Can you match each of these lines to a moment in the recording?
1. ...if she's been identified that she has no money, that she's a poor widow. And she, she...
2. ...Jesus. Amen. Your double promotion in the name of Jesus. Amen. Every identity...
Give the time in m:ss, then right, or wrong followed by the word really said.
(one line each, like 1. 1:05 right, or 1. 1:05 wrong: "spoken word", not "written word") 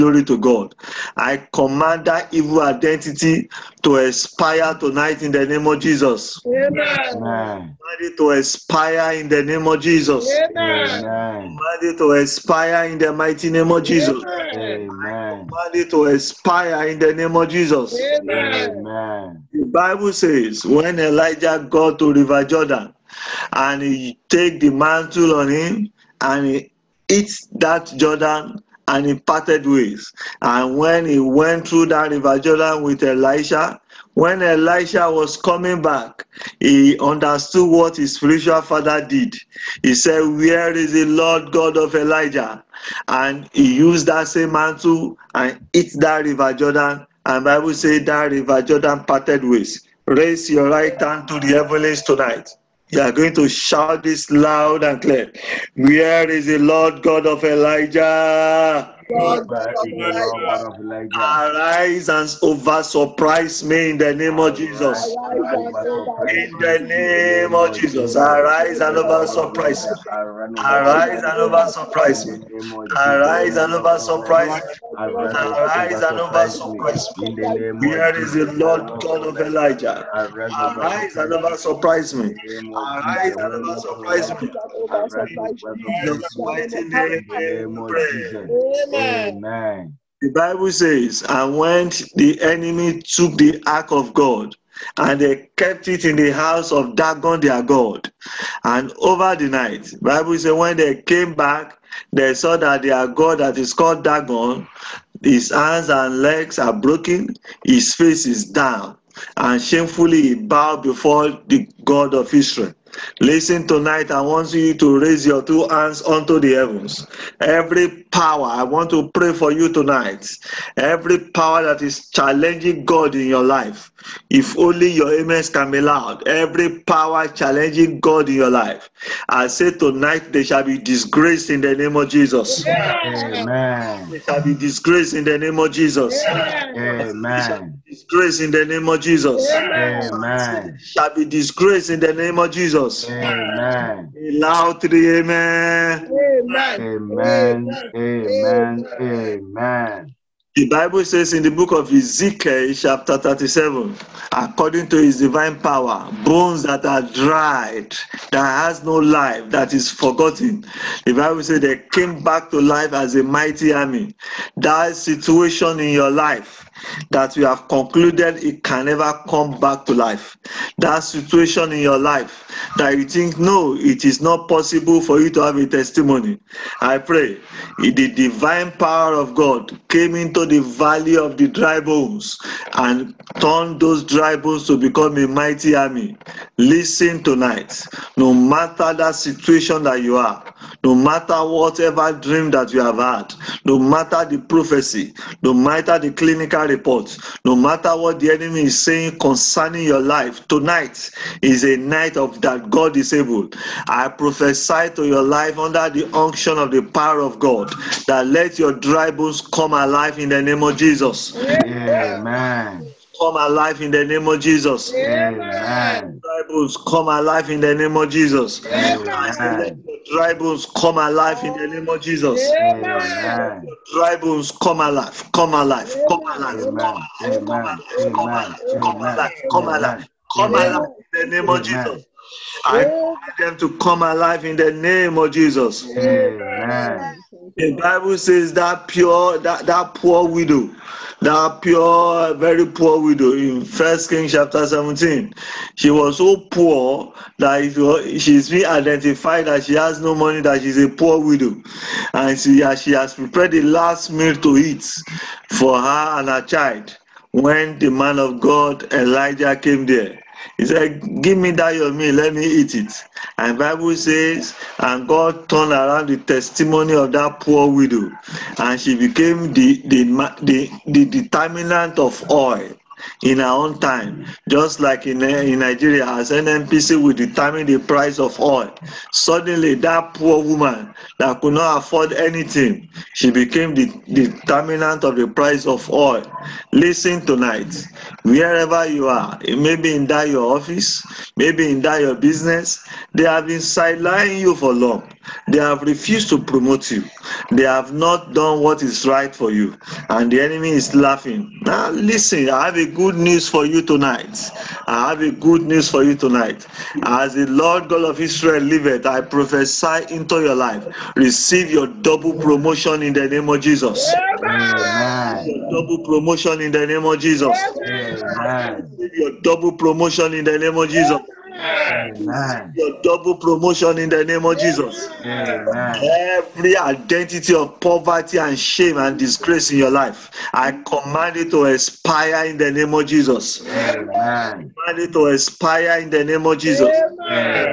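1. 4:07 right
2. 5:20 right.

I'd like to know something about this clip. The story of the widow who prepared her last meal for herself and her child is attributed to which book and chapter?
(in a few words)
First Kings 17.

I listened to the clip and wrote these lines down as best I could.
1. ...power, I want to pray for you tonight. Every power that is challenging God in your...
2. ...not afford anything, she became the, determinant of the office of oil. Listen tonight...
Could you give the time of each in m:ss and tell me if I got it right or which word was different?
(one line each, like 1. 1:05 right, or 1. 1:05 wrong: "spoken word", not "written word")
1. 1:58 right
2. 4:41 wrong: "price", not "office".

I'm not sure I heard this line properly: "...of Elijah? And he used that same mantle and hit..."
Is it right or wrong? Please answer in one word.
right.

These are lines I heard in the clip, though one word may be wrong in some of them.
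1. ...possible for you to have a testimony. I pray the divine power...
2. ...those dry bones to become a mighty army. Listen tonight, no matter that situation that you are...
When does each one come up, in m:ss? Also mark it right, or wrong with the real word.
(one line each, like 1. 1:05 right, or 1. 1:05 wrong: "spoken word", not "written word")
1. 2:54 right
2. 3:03 right.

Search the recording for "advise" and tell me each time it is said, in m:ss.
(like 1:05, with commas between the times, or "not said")
not said.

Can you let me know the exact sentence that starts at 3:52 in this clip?
I want them to come alive in the name of Jesus.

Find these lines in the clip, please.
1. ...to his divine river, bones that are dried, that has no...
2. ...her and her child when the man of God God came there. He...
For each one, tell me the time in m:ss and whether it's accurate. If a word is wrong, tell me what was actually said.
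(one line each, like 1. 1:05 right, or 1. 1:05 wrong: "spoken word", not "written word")
1. 2:34 wrong: "power", not "river"
2. 4:15 wrong: "Elijah", not "God".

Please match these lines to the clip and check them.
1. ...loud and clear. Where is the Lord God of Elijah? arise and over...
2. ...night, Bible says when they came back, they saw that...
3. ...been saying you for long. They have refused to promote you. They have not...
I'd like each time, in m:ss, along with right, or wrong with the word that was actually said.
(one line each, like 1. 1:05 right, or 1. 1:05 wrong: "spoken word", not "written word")
1. 0:54 right
2. 1:39 right
3. 4:53 wrong: "sidelining", not "saying".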